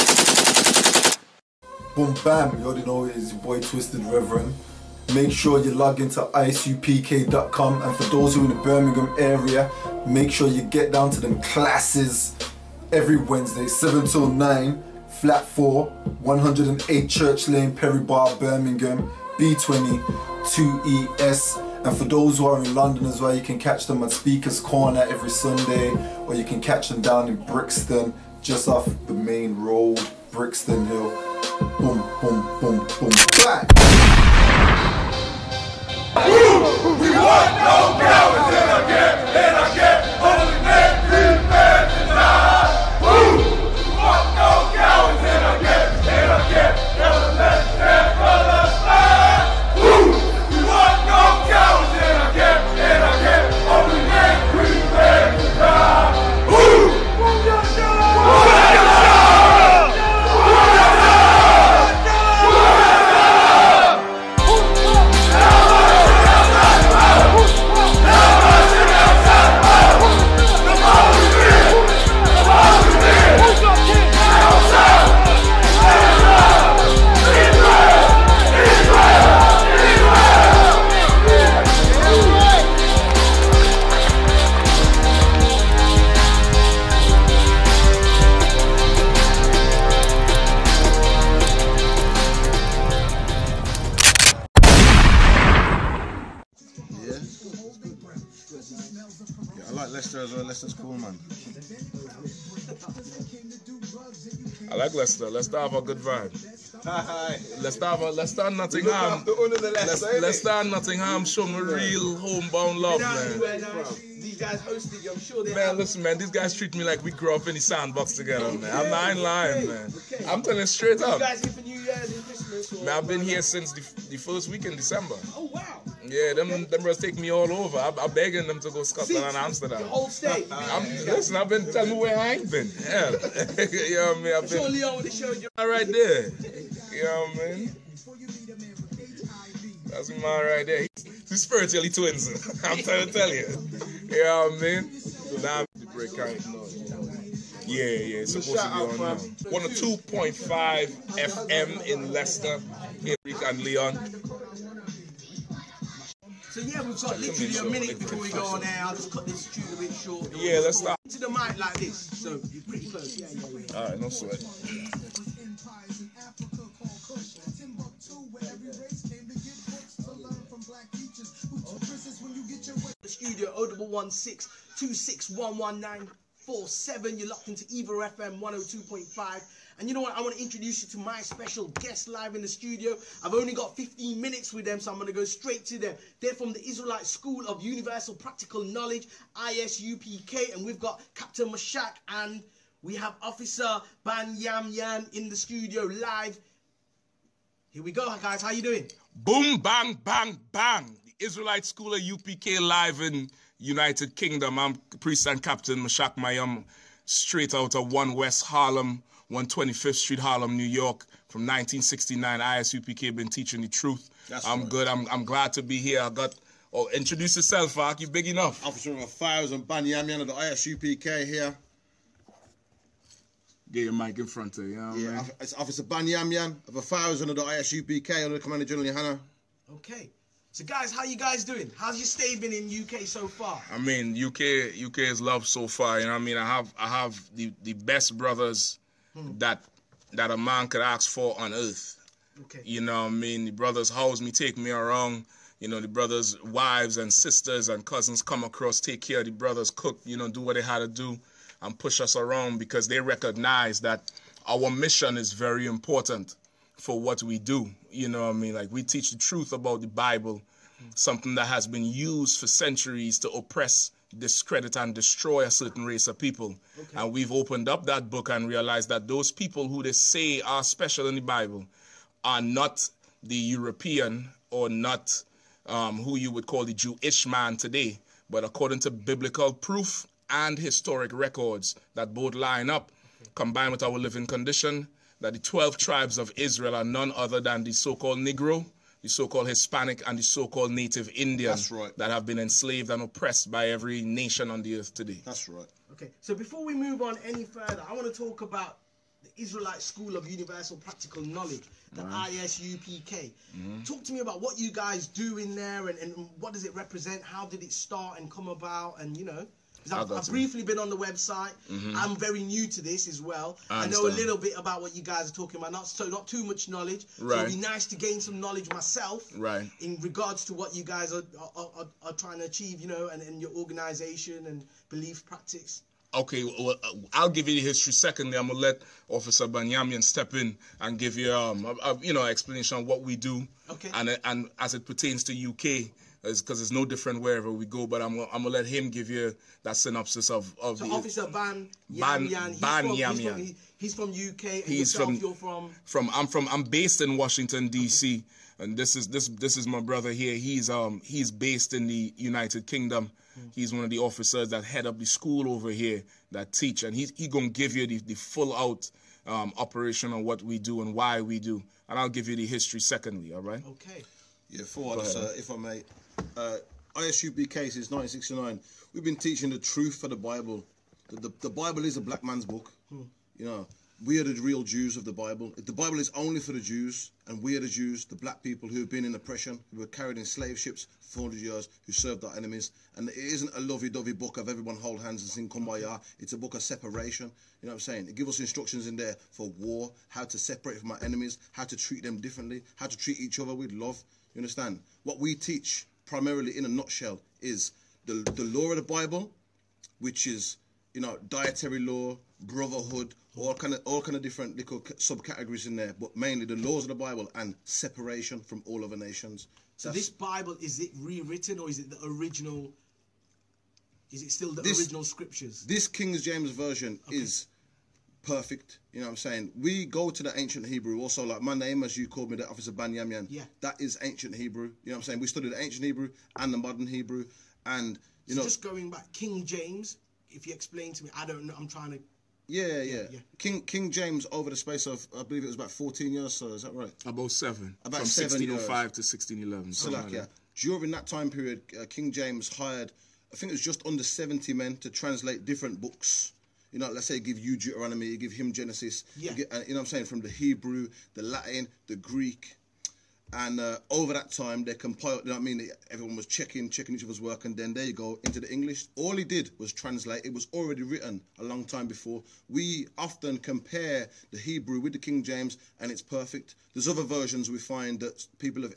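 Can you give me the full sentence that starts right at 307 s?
How did it start and come about?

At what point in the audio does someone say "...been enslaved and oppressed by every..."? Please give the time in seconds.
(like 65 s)
292 s.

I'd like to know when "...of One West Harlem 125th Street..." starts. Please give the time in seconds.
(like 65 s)
207 s.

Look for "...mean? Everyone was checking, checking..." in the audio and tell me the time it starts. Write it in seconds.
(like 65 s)
455 s.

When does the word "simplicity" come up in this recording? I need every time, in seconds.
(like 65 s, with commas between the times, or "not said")
not said.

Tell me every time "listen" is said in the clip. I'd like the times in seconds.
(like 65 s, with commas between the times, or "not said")
115 s, 131 s.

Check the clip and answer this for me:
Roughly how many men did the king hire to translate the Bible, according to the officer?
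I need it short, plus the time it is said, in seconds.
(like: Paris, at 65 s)
just under 70, at 443 s.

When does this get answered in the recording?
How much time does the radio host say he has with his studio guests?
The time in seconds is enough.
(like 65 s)
183 s.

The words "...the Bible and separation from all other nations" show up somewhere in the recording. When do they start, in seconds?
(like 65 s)
406 s.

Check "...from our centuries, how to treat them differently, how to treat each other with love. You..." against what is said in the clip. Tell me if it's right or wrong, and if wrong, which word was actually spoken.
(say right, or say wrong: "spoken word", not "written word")
wrong: "enemies", not "centuries".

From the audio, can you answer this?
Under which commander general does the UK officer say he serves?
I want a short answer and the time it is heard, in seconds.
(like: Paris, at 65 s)
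Yahanna, at 228 s.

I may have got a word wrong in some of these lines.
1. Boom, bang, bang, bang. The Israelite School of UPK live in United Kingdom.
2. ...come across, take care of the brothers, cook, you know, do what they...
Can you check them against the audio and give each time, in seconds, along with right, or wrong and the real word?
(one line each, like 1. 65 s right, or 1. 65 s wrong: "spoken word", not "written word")
1. 199 s right
2. 248 s right.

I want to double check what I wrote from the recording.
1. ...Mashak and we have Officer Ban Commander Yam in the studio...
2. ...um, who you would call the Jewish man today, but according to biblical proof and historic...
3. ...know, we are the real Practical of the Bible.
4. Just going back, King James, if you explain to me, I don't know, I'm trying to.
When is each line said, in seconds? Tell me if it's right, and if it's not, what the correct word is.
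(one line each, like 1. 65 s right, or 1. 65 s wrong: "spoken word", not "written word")
1. 191 s wrong: "Yam", not "Commander"
2. 275 s right
3. 373 s wrong: "Jews", not "Practical"
4. 428 s right.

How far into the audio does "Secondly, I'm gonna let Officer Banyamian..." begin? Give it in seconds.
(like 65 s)
327 s.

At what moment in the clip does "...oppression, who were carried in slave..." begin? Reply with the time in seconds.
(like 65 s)
379 s.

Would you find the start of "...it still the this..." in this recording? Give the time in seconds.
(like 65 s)
414 s.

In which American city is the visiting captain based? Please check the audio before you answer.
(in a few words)
Washington D.C.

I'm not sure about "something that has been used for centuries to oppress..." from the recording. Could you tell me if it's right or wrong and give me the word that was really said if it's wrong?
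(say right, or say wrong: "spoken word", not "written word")
right.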